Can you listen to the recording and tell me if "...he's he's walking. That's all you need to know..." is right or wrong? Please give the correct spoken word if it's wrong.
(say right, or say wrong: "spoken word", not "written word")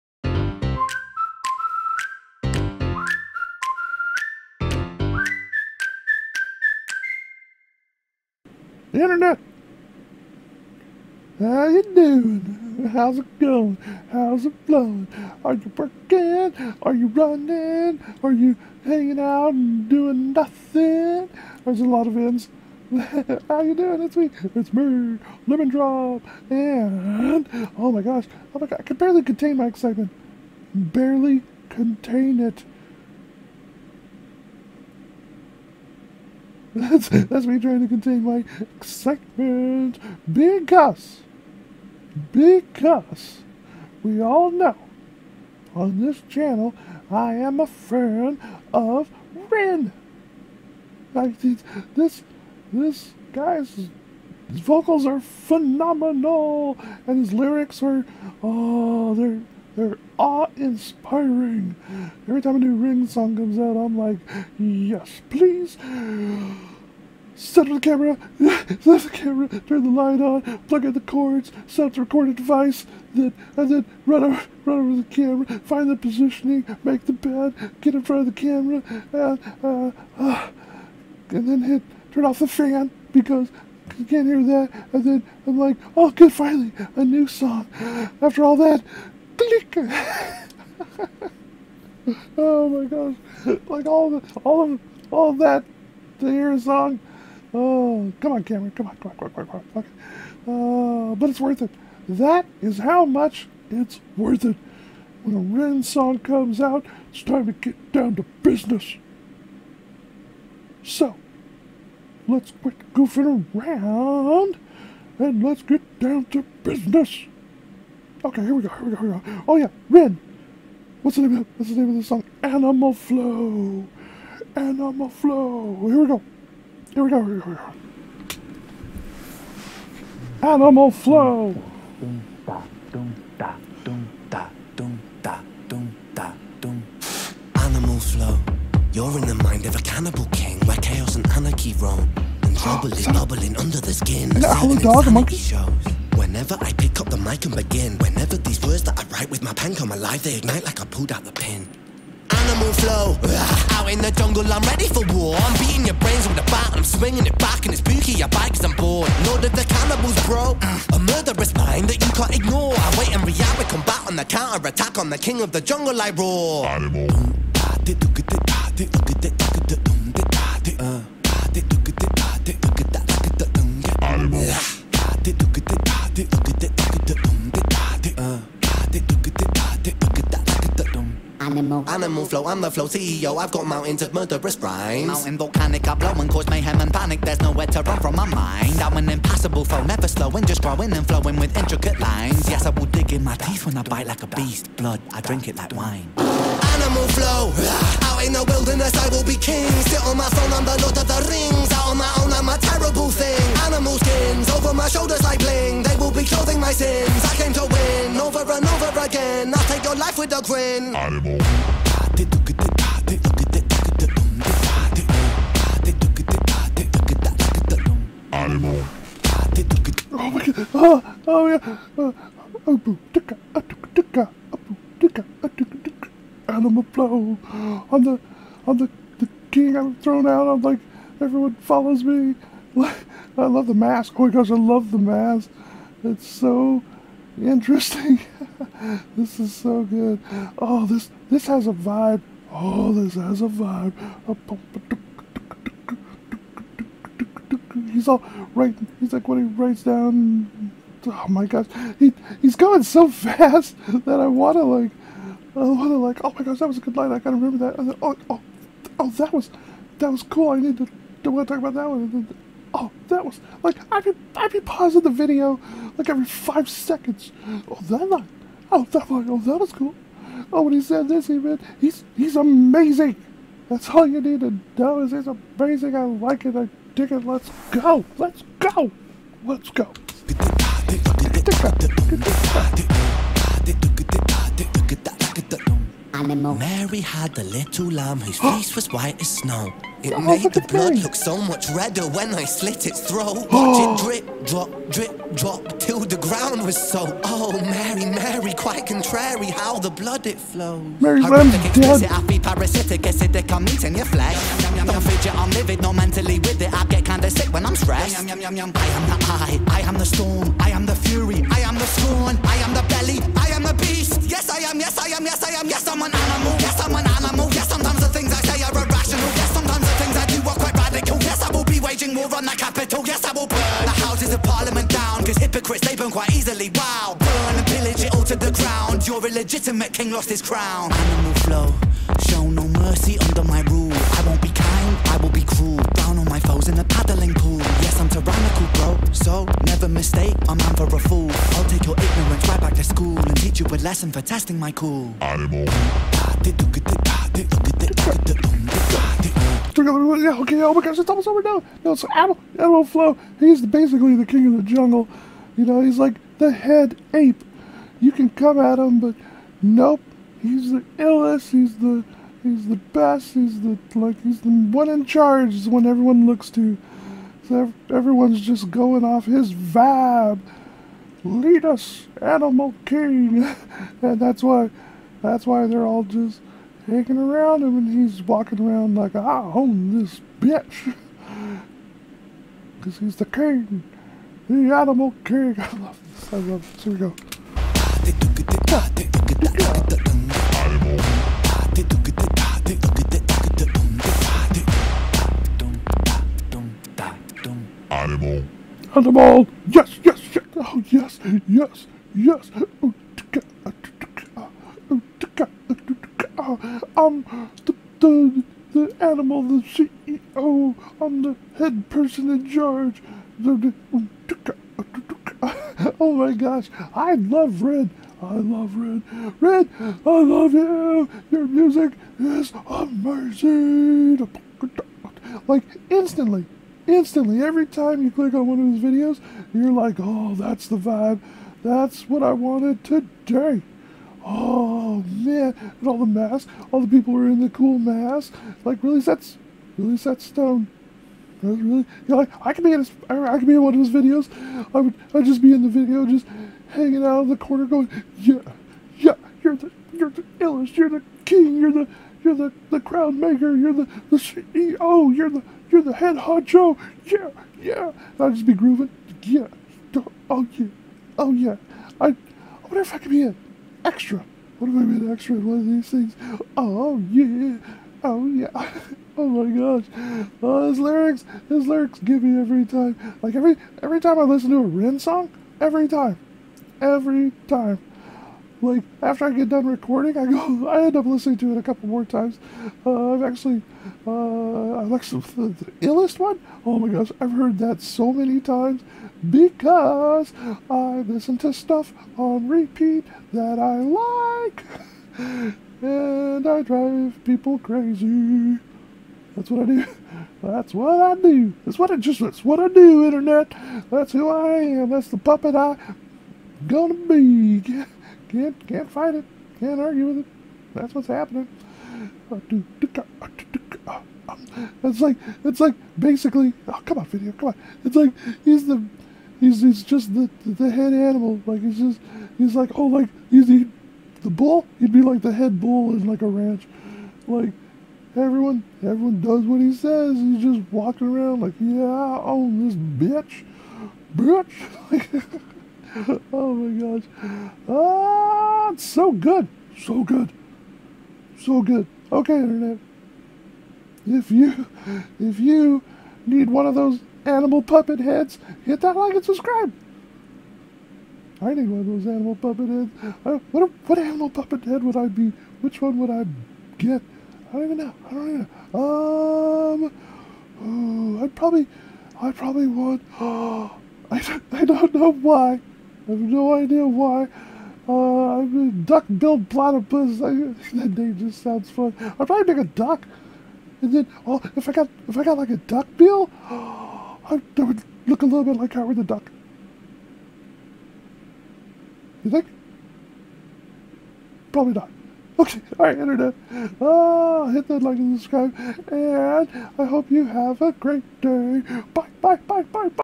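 wrong: "amazing", not "walking".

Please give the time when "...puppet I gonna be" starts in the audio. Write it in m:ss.
8:25.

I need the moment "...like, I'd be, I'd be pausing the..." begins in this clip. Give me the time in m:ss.
4:23.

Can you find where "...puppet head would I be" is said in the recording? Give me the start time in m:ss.
9:14.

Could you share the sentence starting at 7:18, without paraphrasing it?
Like, really, that's really set stone.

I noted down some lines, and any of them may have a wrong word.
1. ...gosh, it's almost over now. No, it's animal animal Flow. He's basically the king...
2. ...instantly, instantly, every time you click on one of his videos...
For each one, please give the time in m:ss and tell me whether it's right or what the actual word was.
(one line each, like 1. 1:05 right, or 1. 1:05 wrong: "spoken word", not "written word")
1. 5:50 right
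2. 7:05 right.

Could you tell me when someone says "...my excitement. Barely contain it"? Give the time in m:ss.
0:29.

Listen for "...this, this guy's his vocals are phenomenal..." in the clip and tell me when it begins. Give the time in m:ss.
0:51.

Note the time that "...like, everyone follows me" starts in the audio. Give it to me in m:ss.
3:50.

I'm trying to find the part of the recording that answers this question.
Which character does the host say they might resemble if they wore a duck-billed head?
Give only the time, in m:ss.
9:38.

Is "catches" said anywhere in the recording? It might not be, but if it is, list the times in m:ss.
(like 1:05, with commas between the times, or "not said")
not said.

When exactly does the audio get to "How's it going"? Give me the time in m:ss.
0:12.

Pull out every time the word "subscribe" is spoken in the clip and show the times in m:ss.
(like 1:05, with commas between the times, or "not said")
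9:09, 9:48.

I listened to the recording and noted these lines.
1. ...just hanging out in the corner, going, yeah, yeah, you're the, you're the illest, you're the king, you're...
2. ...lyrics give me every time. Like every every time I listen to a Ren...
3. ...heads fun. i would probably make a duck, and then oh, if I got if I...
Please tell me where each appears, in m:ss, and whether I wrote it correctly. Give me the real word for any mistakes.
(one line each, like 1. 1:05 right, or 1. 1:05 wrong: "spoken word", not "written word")
1. 7:26 right
2. 7:51 right
3. 9:31 wrong: "sounds", not "heads".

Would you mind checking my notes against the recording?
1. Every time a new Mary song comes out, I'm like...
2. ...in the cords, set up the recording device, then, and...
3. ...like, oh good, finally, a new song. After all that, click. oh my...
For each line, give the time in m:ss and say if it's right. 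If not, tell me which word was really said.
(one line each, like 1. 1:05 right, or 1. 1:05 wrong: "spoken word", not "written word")
1. 1:02 wrong: "Ren", not "Mary"
2. 1:10 right
3. 1:25 right.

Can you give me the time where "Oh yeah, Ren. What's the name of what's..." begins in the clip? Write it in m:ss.
1:59.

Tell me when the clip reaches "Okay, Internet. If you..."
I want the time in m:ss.
9:02.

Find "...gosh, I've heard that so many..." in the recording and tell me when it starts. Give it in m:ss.
8:06.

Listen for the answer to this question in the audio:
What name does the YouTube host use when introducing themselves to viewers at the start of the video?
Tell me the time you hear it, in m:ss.
0:25.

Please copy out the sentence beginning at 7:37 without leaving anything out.
And I'd just be grooving, yeah, oh yeah, oh yeah.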